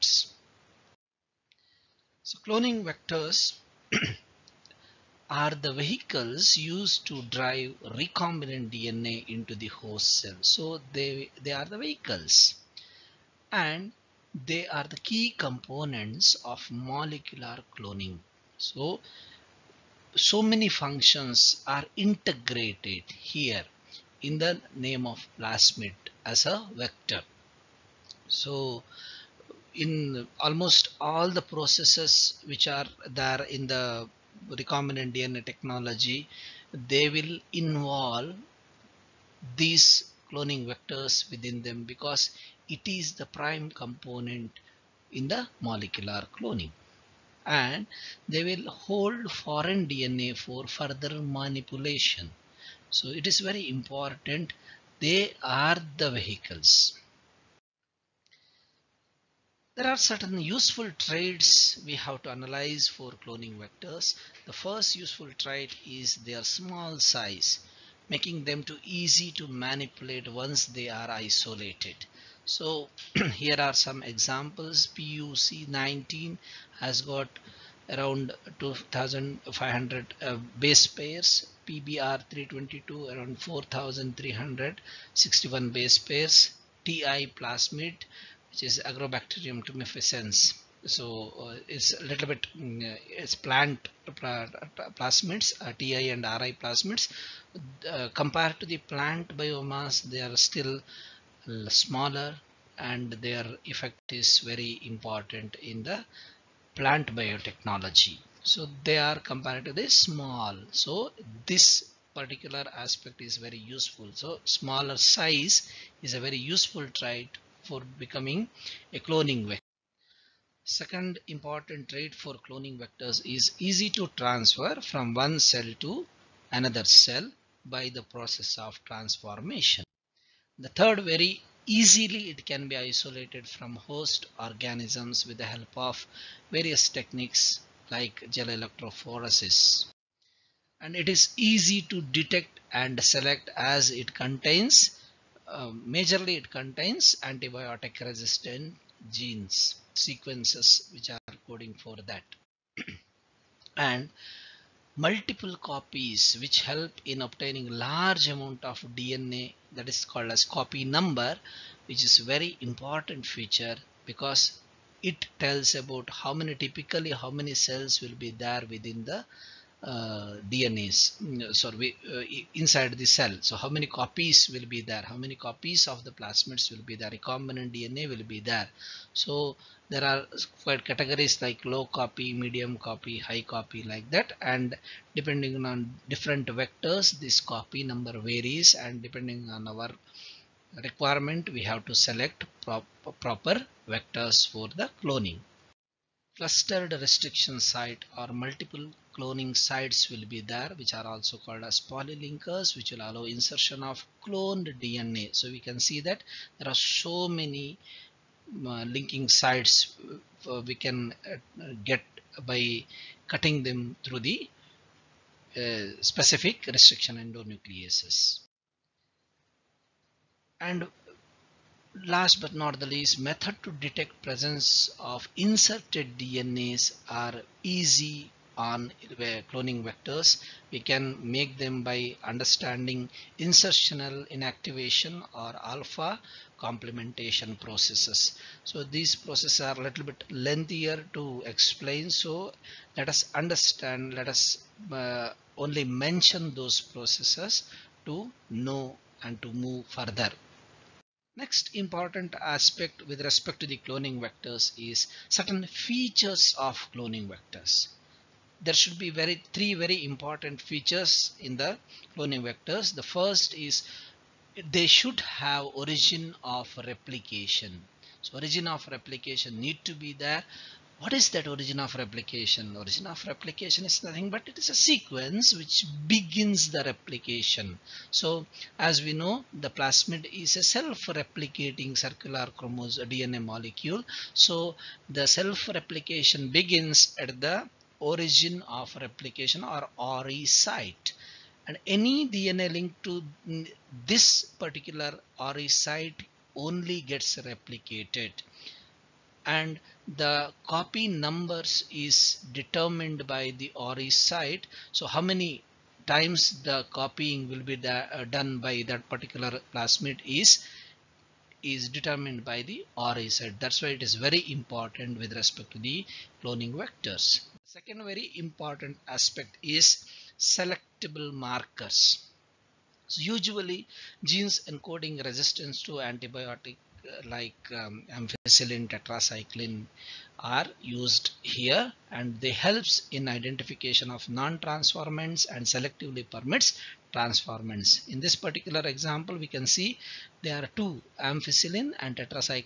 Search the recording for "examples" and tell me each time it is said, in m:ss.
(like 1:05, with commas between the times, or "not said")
1:14, 5:38.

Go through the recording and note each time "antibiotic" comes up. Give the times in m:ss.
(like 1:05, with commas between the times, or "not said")
2:27, 5:26.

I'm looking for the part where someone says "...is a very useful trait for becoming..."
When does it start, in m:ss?
1:56.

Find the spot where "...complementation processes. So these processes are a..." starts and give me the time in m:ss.
3:56.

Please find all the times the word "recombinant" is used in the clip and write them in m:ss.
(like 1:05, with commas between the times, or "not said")
0:07, 0:34, 2:57.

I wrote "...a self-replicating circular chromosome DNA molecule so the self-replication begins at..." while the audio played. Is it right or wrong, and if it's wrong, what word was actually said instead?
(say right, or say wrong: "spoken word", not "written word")
right.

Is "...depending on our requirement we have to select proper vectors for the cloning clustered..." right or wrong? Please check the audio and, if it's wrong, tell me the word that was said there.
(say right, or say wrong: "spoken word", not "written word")
right.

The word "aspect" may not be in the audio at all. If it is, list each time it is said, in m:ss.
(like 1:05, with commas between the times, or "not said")
1:52, 4:12, 5:19.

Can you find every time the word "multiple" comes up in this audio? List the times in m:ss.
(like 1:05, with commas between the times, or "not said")
2:34, 3:18.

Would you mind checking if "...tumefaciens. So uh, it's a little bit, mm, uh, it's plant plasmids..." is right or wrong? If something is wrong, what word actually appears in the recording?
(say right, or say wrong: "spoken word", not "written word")
right.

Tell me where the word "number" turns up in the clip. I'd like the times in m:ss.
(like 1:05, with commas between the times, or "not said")
2:40, 3:07, 5:01.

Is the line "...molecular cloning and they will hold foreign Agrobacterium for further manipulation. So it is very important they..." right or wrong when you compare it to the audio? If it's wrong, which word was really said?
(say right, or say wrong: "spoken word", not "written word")
wrong: "DNA", not "Agrobacterium".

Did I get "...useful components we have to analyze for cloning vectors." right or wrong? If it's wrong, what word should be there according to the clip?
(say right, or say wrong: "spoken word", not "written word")
wrong: "traits", not "components".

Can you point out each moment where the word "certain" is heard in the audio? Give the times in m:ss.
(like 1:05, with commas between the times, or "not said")
0:59, 4:15.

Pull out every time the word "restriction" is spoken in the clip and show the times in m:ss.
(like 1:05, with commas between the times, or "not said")
3:16, 3:36.